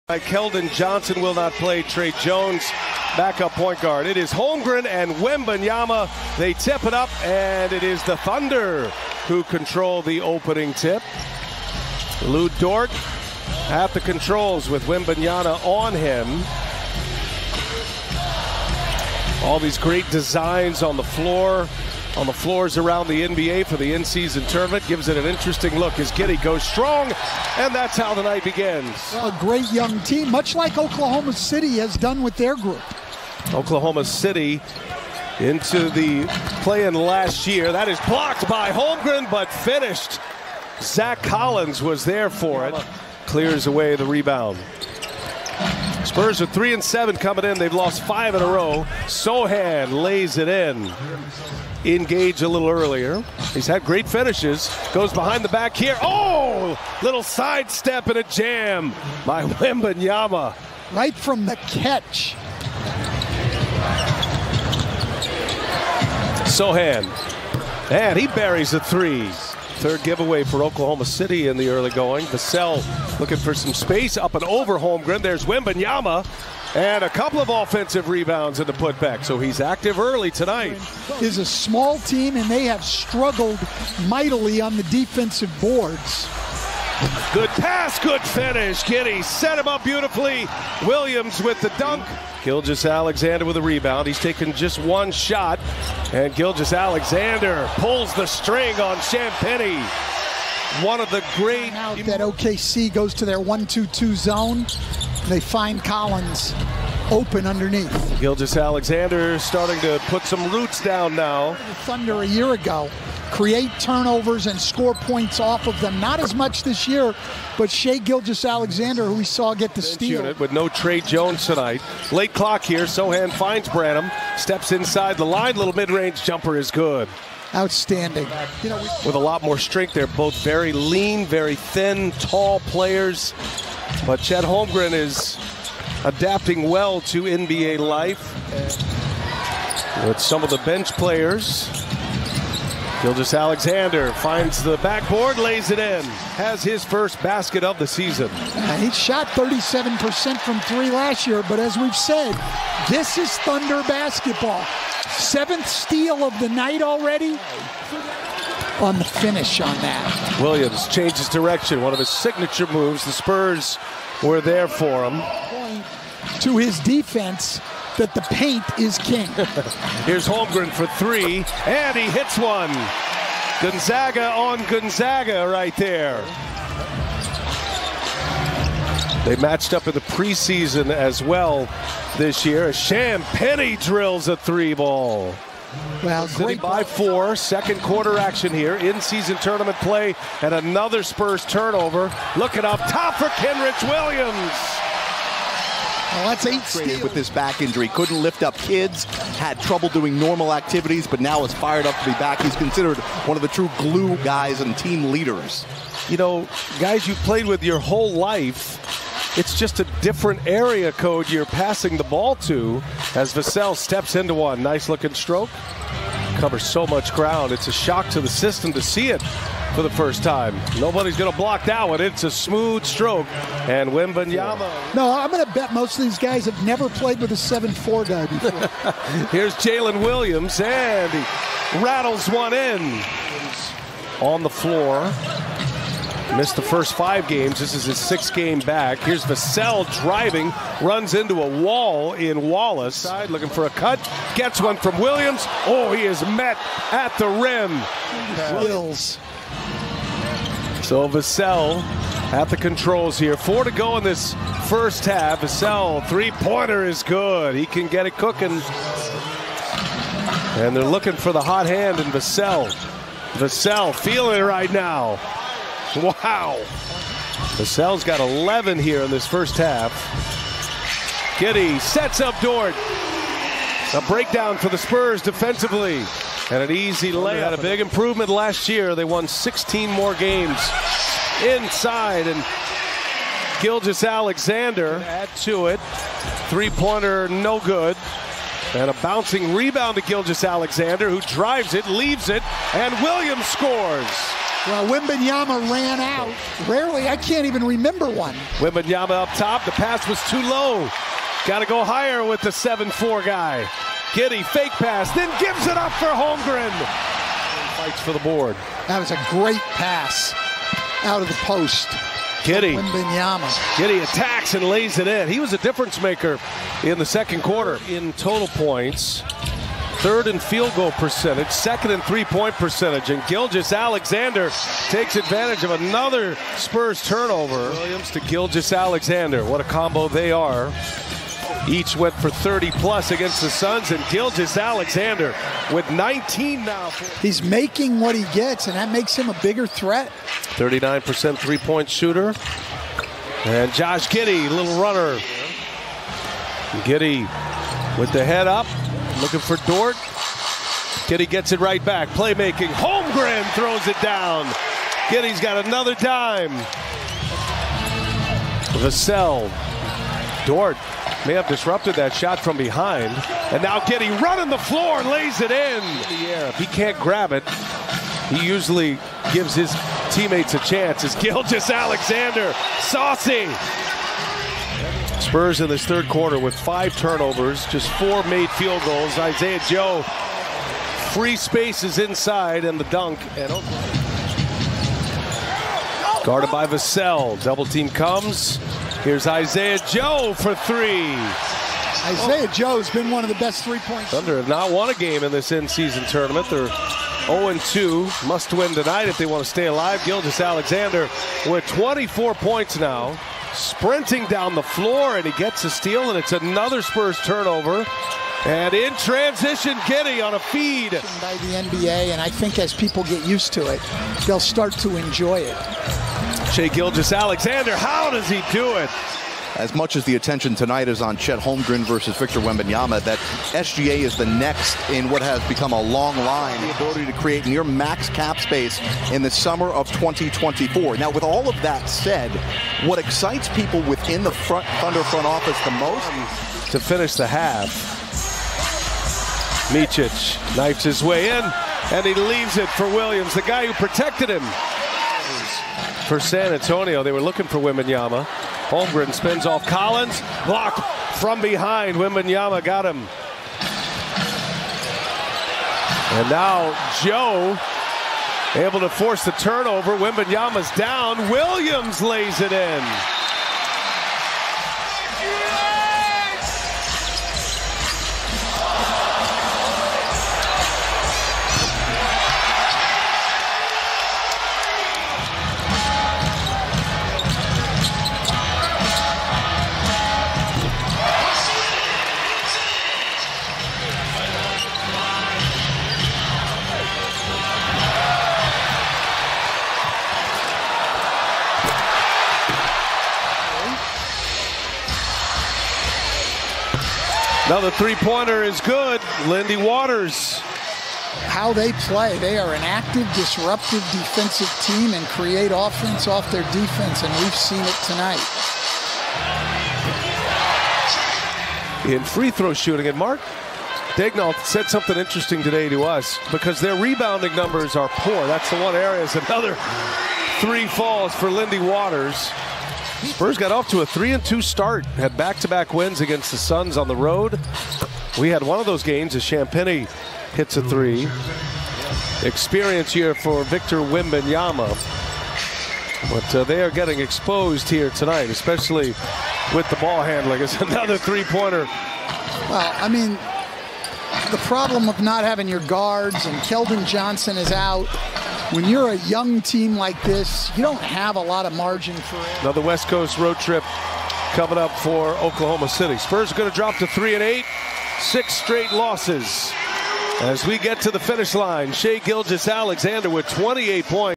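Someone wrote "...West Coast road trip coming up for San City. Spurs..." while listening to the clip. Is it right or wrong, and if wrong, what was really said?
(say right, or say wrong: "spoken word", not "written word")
wrong: "Oklahoma", not "San".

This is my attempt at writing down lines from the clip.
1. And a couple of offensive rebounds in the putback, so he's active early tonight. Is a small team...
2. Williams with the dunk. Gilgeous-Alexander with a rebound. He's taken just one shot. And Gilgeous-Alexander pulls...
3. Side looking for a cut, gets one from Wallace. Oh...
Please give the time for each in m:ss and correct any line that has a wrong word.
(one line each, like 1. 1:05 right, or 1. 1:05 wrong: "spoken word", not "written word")
1. 1:16 right
2. 1:30 right
3. 4:02 wrong: "Williams", not "Wallace".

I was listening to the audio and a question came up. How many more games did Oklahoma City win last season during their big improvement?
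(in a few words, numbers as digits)
16.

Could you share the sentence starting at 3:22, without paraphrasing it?
He's considered one of the true glue guys and team leaders.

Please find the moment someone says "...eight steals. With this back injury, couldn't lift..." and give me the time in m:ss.
3:16.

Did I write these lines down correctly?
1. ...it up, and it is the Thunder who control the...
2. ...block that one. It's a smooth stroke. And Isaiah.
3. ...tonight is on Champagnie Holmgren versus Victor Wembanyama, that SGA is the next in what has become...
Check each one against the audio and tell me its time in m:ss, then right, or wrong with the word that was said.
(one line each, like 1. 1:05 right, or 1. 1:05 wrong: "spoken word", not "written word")
1. 0:06 right
2. 3:41 wrong: "Wembanyama", not "Isaiah"
3. 7:00 wrong: "Chet", not "Champagnie".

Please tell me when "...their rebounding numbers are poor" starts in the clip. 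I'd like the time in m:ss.
8:36.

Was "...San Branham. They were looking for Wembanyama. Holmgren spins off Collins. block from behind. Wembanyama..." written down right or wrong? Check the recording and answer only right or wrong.
wrong.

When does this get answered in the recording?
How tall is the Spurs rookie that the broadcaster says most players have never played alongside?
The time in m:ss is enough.
3:47.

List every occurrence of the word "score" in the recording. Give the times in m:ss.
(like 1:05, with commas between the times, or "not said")
1:54, 4:53.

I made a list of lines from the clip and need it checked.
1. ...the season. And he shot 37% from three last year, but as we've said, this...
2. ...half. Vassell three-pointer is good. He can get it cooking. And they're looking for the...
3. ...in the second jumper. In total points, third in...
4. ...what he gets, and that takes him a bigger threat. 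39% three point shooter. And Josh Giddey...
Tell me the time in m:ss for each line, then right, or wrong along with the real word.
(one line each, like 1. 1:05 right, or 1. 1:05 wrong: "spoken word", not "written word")
1. 2:27 right
2. 4:15 right
3. 5:16 wrong: "quarter", not "jumper"
4. 5:37 wrong: "makes", not "takes".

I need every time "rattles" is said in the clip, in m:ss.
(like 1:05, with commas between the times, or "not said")
3:51.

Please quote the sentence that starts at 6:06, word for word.
If he can't grab it, he usually gives his teammates a chance.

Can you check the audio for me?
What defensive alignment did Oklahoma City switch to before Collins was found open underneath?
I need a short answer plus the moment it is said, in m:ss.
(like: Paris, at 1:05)
1 2 2 zone, at 1:43.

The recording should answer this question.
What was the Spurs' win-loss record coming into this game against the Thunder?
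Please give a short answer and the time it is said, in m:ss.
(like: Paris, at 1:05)
3 and 7, at 0:46.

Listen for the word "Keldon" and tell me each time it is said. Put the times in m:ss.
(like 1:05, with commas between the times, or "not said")
0:00, 9:06.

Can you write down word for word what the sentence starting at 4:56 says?
Rarely, I can't even remember one.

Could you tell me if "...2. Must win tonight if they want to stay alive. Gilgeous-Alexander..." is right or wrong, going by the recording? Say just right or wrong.
right.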